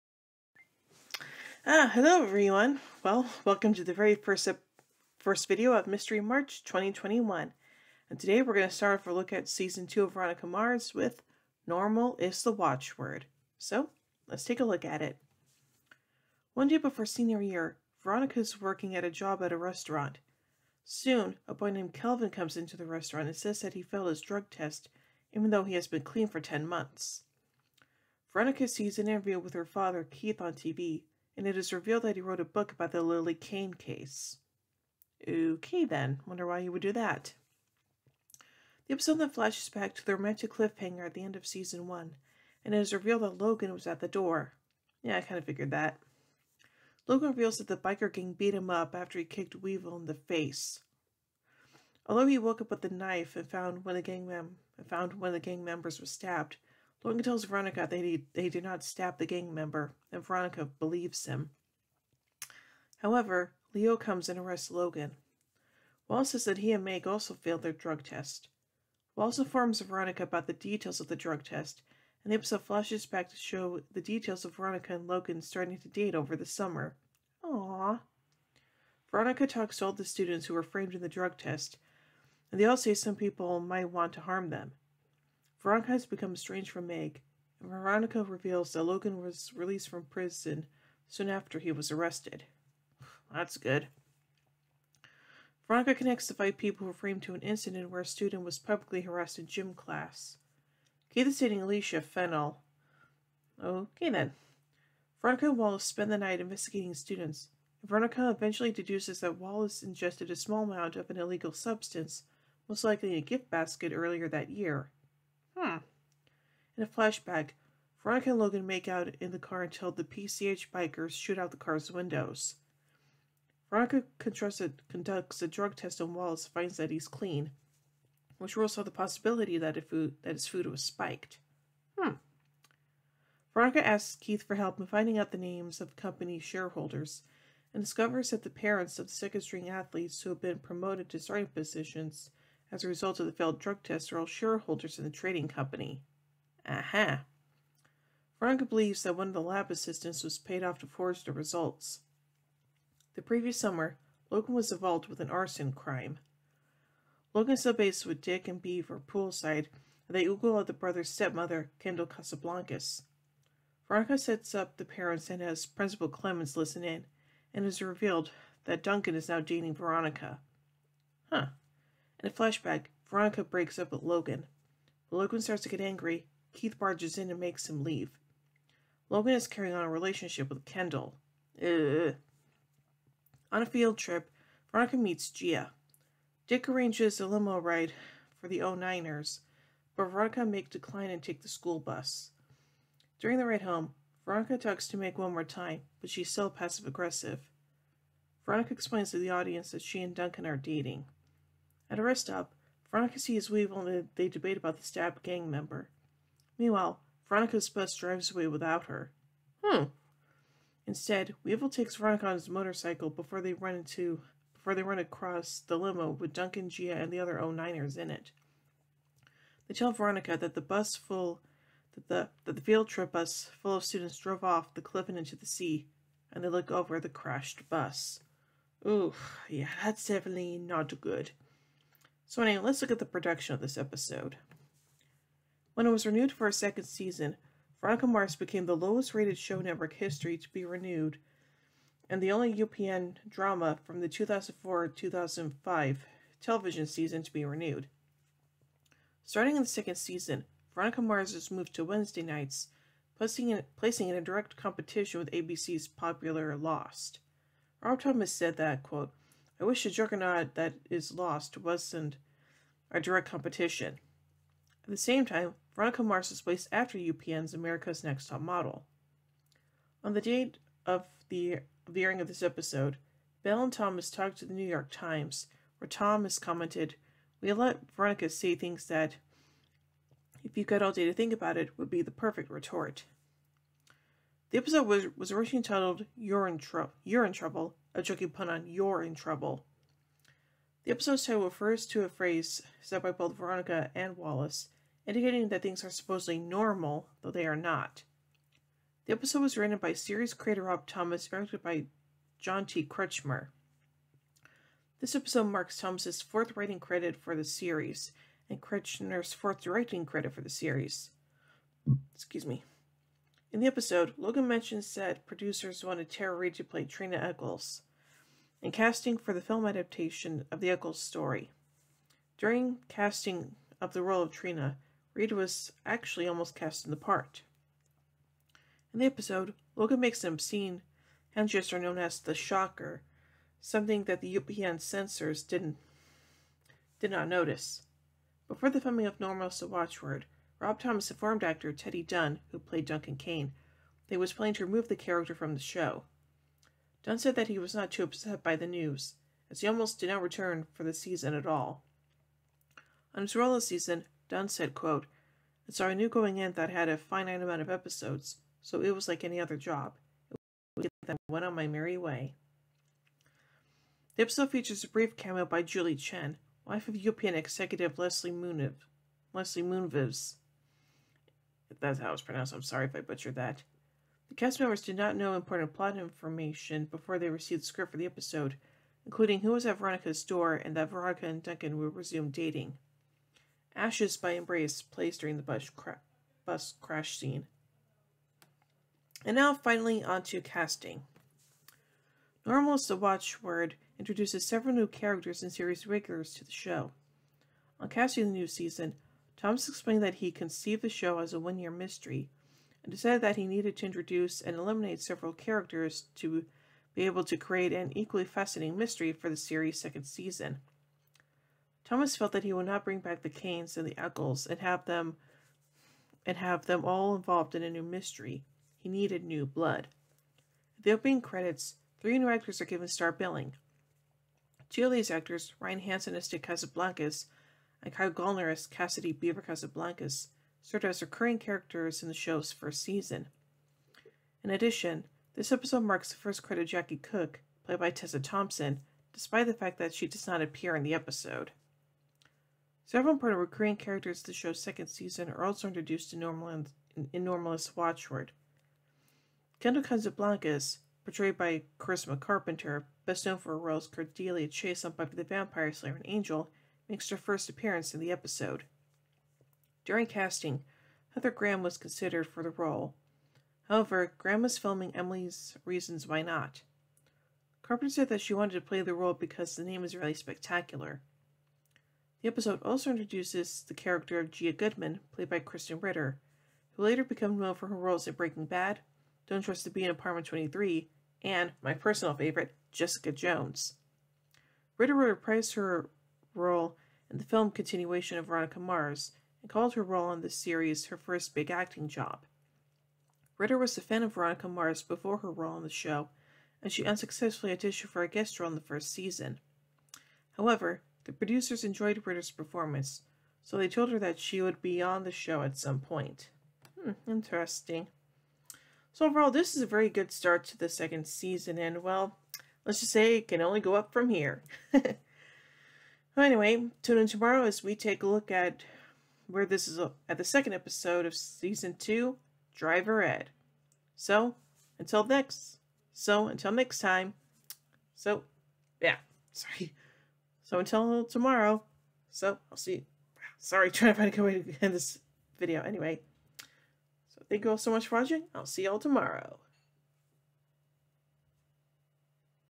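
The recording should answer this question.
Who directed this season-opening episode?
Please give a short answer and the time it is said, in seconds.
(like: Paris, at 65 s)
John T. Kretschmer, at 302 s.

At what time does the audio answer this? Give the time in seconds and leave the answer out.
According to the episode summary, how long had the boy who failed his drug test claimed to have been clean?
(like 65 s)
26 s.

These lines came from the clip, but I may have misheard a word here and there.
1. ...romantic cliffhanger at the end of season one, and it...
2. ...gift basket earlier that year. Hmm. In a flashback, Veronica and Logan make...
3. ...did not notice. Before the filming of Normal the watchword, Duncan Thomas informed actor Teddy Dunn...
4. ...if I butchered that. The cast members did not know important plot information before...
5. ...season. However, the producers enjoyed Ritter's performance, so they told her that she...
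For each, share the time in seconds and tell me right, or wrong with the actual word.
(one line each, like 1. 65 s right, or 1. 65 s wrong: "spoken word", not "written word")
1. 40 s right
2. 113 s right
3. 337 s wrong: "Rob", not "Duncan"
4. 372 s right
5. 498 s right.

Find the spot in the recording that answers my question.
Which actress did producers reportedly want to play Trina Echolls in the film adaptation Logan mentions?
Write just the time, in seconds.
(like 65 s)
316 s.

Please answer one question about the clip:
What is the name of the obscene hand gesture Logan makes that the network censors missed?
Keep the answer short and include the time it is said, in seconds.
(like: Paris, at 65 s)
the shocker, at 332 s.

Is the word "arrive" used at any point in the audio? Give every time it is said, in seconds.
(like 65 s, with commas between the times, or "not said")
not said.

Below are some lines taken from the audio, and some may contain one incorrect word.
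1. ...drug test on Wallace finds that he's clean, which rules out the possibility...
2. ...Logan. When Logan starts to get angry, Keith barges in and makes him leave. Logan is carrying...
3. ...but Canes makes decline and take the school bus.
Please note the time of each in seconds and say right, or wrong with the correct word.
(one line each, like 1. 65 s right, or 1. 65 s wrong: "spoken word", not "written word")
1. 125 s right
2. 174 s right
3. 189 s wrong: "Veronica", not "Canes".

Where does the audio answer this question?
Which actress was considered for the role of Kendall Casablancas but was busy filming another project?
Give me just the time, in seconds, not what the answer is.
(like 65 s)
461 s.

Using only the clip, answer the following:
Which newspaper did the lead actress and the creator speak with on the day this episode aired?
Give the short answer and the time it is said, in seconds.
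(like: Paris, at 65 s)
New York Times, at 274 s.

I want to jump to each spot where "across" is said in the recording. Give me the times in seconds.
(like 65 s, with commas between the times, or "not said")
214 s.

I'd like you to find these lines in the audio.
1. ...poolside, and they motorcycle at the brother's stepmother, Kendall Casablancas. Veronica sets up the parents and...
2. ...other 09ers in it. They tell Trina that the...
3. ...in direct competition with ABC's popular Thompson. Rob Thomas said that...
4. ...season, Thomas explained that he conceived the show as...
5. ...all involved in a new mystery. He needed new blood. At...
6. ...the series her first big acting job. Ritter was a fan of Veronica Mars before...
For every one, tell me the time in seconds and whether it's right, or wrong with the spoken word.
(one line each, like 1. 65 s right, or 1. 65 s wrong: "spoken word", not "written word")
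1. 158 s wrong: "google", not "motorcycle"
2. 217 s wrong: "Veronica", not "Trina"
3. 254 s wrong: "Lost", not "Thompson"
4. 398 s right
5. 416 s right
6. 490 s right.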